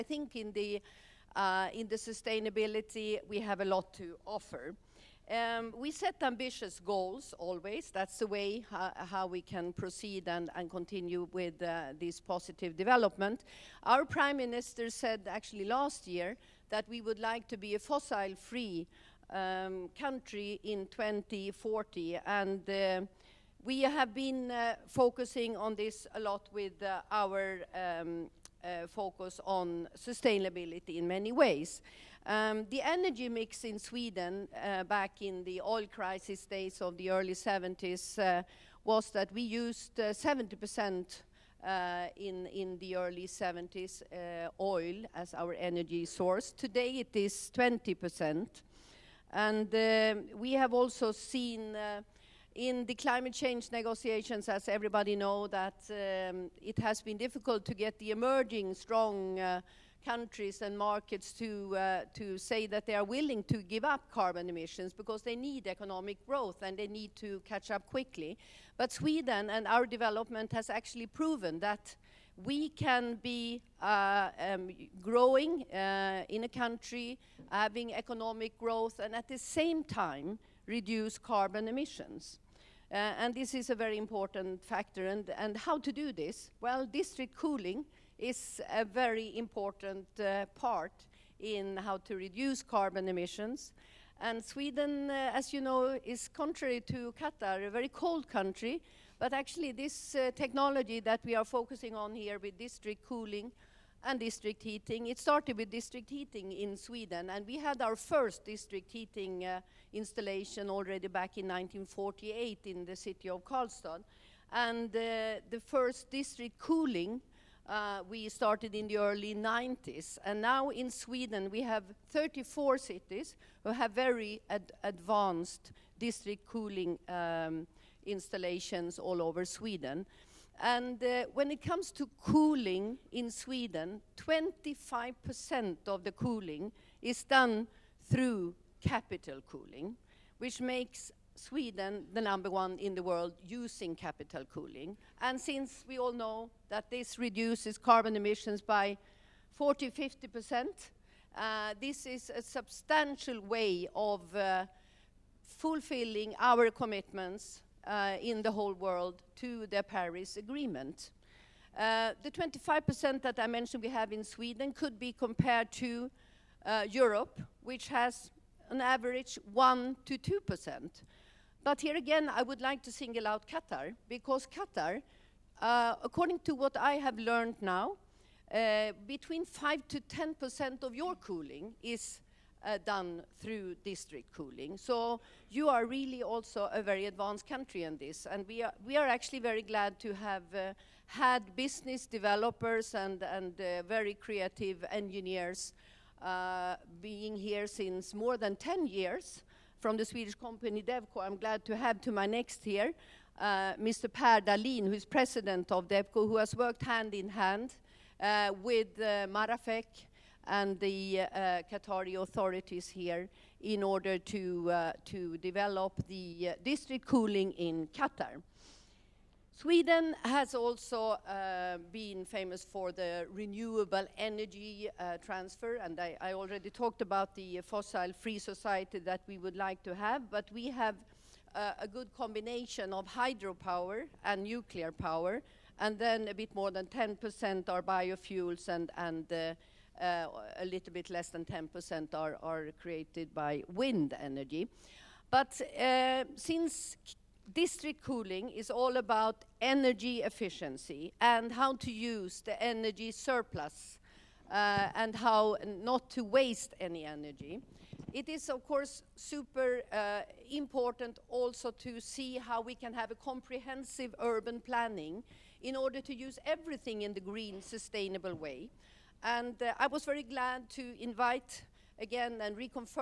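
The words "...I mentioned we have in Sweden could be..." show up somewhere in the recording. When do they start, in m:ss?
2:43.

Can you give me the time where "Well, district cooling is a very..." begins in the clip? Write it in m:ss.
1:26.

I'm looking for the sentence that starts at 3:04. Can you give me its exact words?
So you are really also a very advanced country in this.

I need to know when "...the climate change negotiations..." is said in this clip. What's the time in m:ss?
0:52.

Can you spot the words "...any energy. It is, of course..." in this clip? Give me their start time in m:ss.
4:16.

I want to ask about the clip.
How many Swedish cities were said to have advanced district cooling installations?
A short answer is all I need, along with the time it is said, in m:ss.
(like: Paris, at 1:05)
34, at 2:02.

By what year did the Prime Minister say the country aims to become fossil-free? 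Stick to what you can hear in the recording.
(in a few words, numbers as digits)
2040.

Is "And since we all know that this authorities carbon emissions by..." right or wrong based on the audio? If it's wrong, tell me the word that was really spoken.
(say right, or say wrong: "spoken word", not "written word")
wrong: "reduces", not "authorities".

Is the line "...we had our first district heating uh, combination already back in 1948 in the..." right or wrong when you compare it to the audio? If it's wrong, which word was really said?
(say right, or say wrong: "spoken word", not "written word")
wrong: "installation", not "combination".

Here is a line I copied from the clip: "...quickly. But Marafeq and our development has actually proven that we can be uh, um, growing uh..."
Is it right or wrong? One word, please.
wrong.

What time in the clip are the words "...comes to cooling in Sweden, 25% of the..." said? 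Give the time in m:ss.
2:11.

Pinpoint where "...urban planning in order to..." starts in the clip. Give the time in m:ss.
4:24.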